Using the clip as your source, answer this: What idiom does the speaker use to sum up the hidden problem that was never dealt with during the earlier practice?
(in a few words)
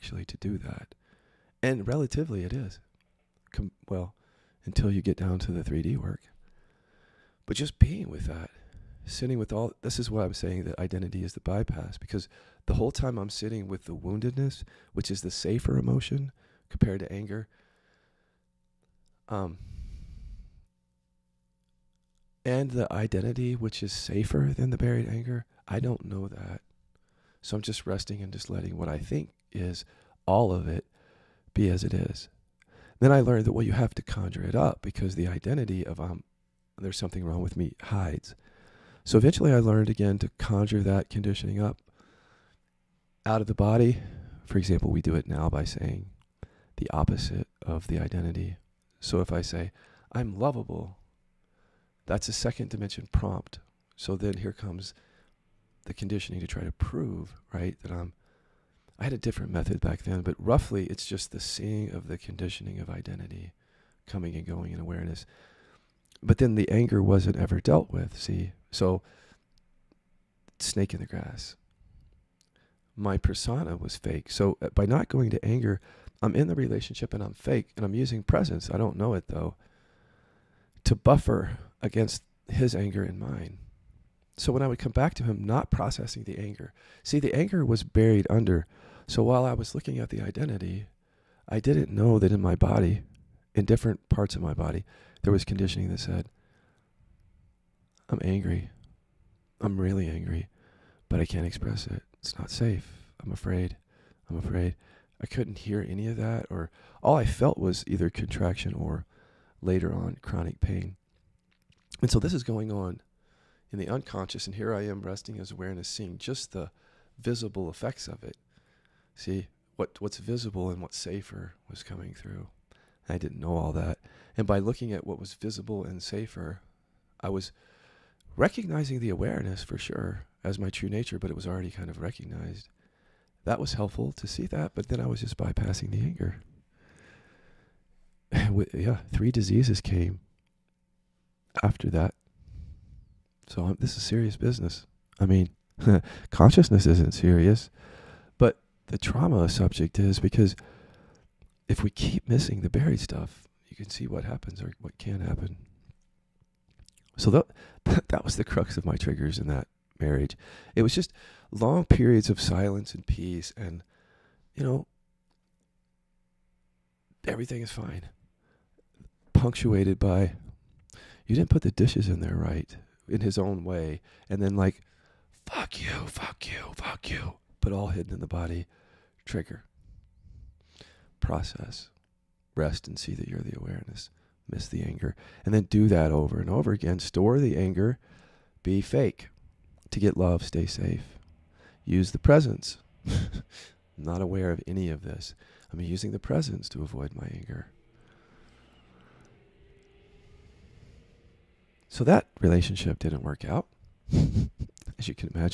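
snake in the grass.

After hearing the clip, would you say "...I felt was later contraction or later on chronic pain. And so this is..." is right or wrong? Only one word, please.
wrong.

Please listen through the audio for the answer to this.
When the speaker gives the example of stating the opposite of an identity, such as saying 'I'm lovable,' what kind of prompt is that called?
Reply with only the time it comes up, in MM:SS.
00:52.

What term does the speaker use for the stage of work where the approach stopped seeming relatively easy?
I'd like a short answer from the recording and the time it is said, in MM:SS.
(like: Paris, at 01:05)
3D work, at 00:05.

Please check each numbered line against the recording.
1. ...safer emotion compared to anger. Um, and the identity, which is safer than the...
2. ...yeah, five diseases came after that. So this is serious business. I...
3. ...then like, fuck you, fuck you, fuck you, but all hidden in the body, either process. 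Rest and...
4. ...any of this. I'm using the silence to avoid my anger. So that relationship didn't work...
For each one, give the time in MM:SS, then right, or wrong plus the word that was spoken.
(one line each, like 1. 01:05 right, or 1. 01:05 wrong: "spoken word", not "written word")
1. 00:15 right
2. 02:18 wrong: "three", not "five"
3. 02:54 wrong: "trigger", not "either"
4. 03:14 wrong: "presence", not "silence".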